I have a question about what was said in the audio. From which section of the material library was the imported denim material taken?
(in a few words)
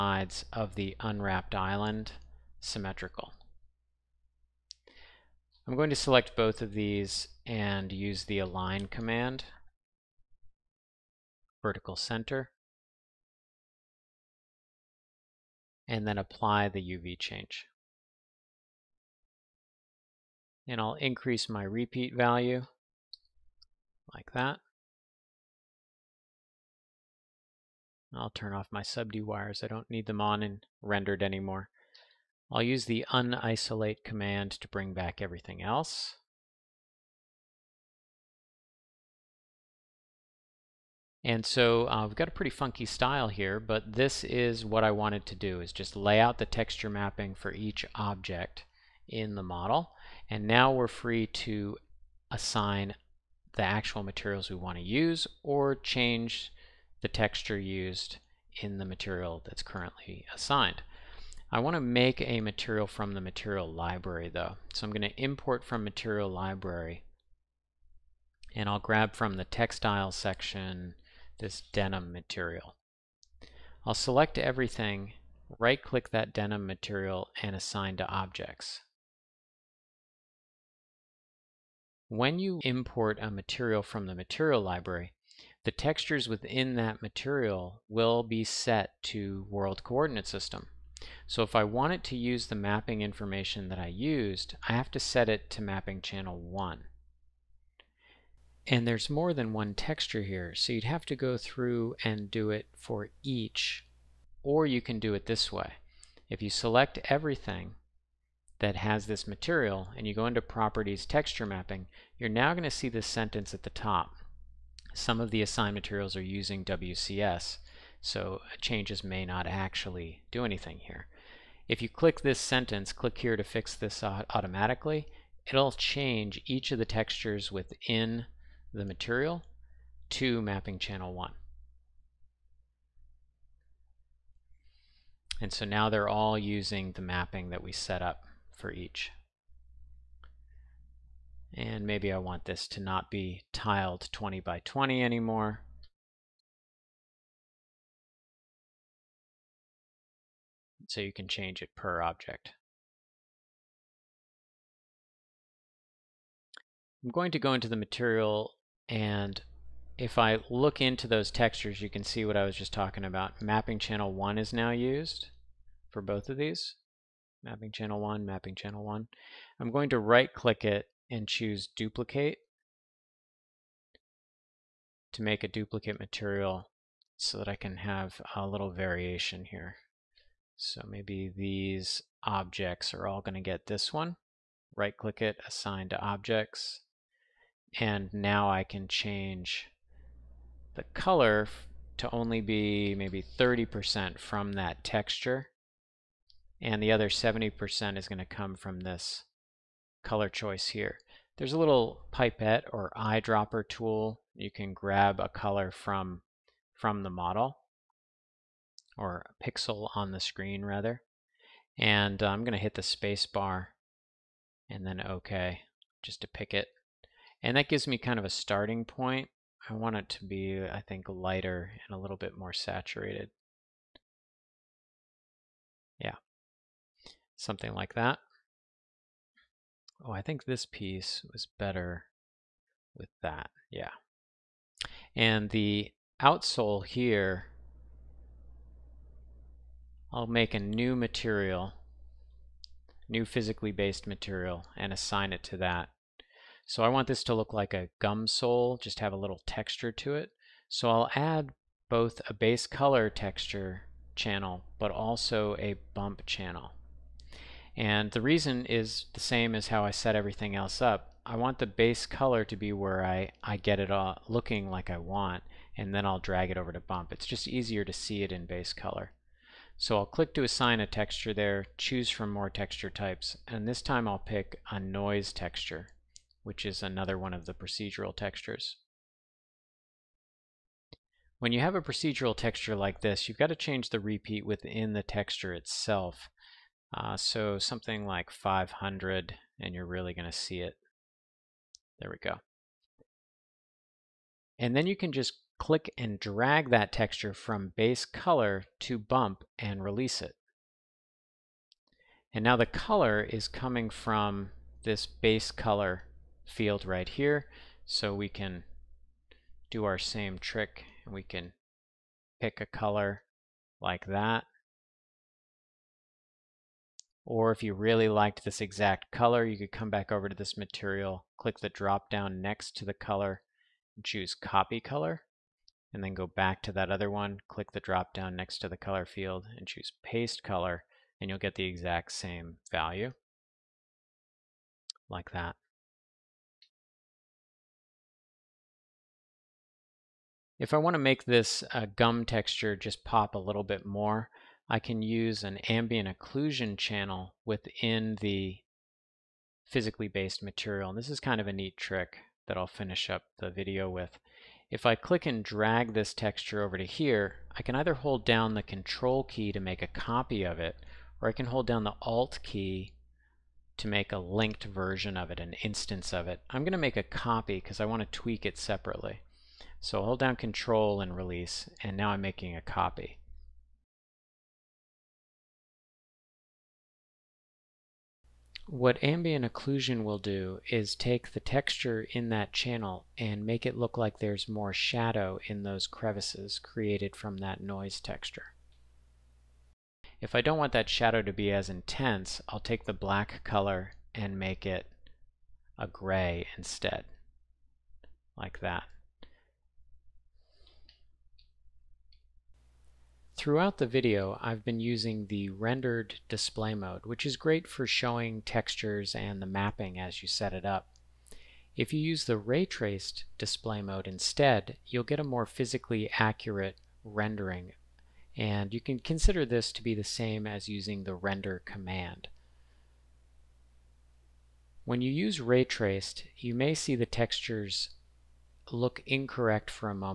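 Textile.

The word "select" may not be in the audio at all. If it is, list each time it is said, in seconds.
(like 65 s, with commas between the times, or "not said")
5 s, 73 s, 106 s.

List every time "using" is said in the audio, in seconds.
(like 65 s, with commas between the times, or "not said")
116 s, 136 s, 404 s, 420 s.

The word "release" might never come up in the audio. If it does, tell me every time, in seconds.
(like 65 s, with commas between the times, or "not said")
299 s, 371 s.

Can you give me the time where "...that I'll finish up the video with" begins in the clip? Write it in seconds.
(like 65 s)
352 s.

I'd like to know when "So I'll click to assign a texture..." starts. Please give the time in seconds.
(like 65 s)
269 s.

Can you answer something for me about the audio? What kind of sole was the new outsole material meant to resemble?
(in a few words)
A gum sole.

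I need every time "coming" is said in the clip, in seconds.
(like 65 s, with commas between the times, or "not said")
303 s.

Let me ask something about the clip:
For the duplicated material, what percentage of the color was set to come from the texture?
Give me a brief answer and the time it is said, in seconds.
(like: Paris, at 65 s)
30%, at 193 s.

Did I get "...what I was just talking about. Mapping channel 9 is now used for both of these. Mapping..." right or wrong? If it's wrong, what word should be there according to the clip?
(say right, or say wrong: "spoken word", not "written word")
wrong: "1", not "9".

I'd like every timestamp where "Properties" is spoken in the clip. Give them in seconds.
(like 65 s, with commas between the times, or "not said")
110 s.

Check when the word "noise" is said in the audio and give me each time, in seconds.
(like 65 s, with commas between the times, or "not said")
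274 s, 387 s.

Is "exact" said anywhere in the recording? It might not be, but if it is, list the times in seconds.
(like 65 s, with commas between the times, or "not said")
318 s, 331 s.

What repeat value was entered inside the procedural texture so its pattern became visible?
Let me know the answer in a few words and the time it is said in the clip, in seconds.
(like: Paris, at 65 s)
500, at 288 s.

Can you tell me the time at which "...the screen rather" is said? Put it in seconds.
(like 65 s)
210 s.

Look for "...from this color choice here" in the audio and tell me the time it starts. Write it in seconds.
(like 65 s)
198 s.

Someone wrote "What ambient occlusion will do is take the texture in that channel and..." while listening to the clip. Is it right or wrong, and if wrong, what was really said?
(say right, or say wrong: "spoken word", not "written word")
right.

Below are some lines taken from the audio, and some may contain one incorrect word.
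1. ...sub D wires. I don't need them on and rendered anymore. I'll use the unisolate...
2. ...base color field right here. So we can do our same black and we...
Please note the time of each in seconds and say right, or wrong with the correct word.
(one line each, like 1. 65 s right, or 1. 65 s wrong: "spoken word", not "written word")
1. 28 s right
2. 305 s wrong: "trick", not "black".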